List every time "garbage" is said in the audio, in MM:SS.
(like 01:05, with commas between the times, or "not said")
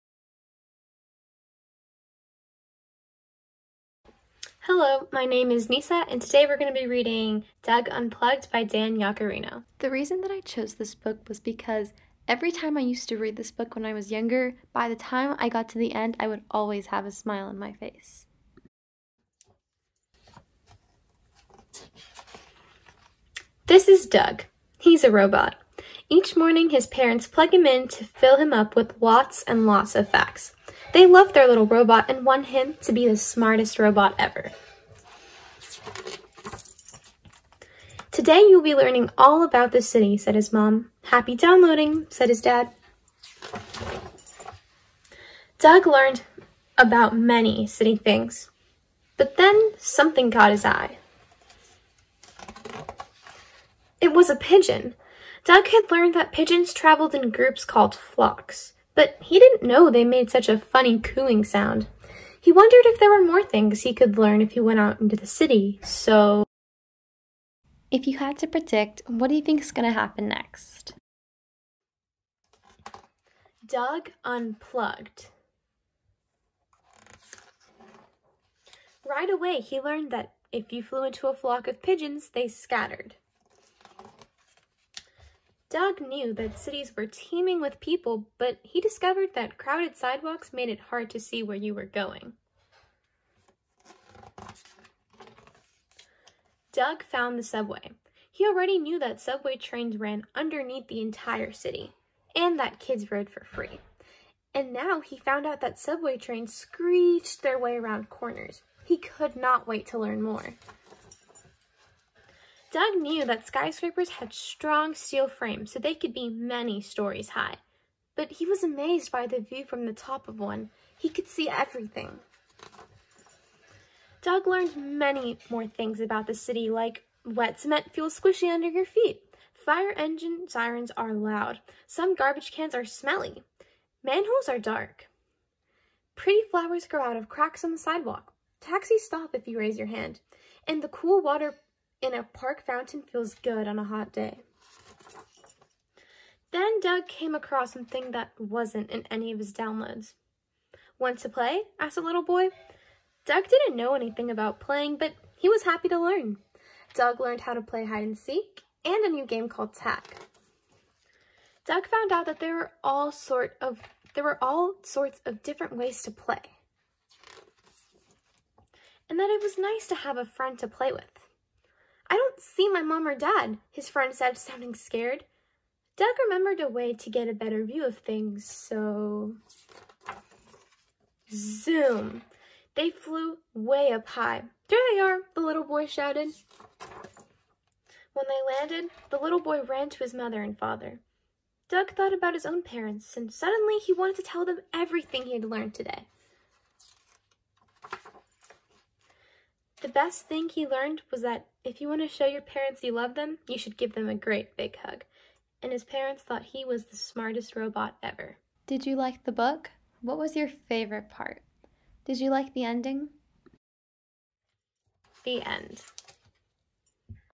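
02:12.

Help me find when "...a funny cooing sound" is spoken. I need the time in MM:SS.
01:00.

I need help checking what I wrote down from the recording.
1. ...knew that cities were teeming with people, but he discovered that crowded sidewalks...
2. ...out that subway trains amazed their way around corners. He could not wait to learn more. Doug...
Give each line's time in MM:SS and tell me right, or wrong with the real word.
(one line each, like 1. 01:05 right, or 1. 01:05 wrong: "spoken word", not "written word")
1. 01:26 right
2. 01:45 wrong: "screeched", not "amazed".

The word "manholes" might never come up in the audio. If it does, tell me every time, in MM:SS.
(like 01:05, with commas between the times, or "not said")
02:14.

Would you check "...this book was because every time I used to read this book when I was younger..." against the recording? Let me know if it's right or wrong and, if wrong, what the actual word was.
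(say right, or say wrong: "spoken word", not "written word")
right.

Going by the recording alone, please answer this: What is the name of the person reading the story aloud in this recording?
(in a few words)
Nysa.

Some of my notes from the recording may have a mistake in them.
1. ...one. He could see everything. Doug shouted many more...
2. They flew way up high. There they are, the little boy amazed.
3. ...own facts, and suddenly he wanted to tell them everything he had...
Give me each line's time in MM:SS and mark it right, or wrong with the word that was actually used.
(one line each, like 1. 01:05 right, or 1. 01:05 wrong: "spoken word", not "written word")
1. 02:00 wrong: "learned", not "shouted"
2. 03:02 wrong: "shouted", not "amazed"
3. 03:12 wrong: "parents", not "facts".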